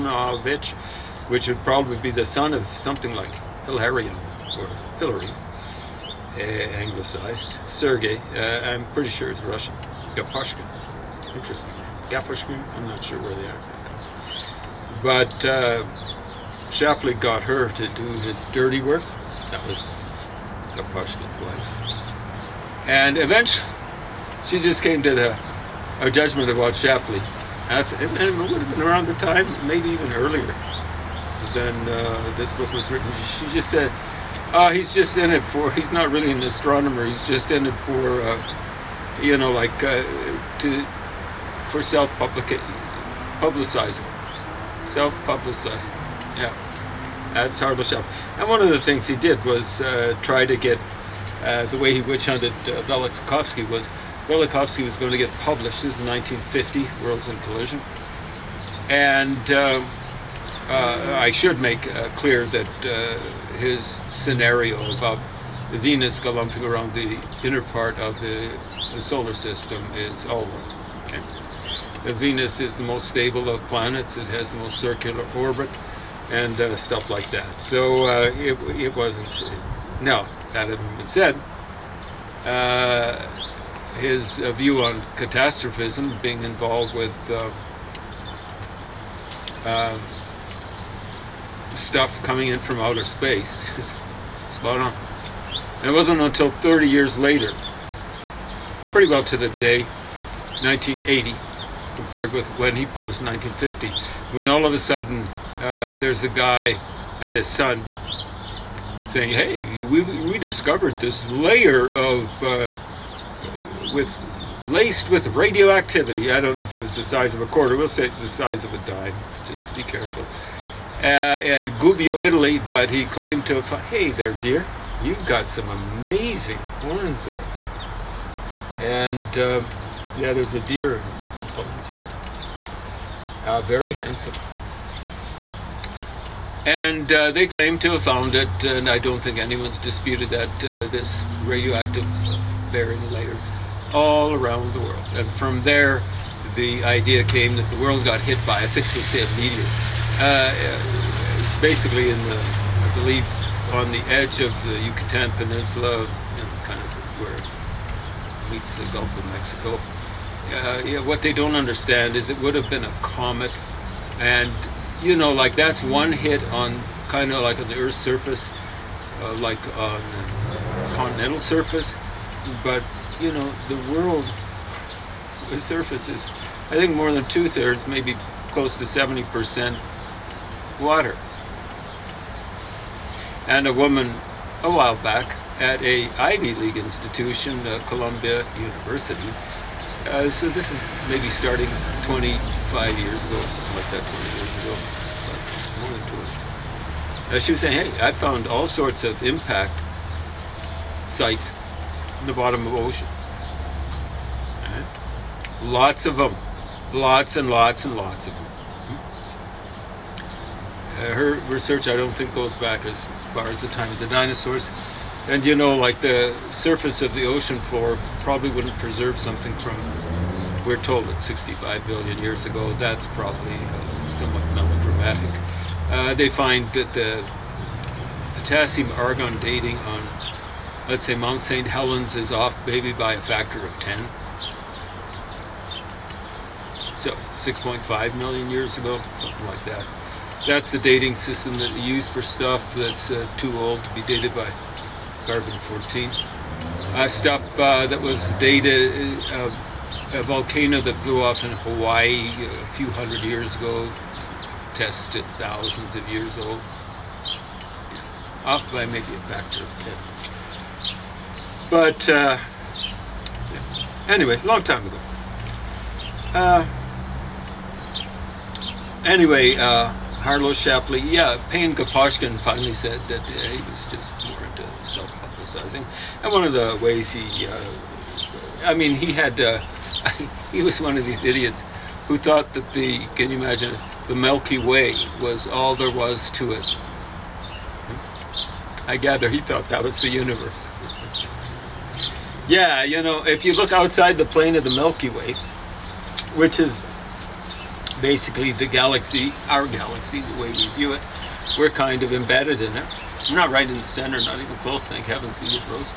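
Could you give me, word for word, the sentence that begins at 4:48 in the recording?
I gather he thought that was the universe.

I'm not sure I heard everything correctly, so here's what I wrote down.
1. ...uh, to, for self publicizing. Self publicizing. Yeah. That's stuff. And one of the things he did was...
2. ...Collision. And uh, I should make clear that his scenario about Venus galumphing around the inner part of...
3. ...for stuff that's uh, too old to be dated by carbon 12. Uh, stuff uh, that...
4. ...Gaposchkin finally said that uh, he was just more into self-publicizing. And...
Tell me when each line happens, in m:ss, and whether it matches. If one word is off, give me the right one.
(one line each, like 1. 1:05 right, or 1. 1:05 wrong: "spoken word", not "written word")
1. 0:39 right
2. 0:57 right
3. 4:02 wrong: "14", not "12"
4. 4:31 right.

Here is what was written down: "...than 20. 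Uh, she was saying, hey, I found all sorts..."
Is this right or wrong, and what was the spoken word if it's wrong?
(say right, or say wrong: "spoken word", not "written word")
right.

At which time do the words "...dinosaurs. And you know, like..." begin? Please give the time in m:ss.
3:34.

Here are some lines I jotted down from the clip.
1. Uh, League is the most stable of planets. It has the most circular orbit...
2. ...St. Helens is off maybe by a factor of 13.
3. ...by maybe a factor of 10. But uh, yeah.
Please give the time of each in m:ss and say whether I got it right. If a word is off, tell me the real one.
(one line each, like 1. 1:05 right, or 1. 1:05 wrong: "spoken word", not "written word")
1. 1:11 wrong: "Venus", not "League"
2. 3:51 wrong: "10", not "13"
3. 4:18 right.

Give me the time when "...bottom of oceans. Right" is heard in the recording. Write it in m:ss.
3:22.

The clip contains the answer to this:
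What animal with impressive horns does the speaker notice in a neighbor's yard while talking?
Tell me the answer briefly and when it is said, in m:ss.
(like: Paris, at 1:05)
deer, at 2:10.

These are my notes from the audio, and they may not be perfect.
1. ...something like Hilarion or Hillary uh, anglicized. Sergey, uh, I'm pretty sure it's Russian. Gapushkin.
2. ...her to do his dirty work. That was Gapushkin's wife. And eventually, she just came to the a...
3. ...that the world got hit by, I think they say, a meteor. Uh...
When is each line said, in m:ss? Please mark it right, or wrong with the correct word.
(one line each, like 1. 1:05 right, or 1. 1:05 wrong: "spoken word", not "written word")
1. 0:02 right
2. 0:17 right
3. 2:27 right.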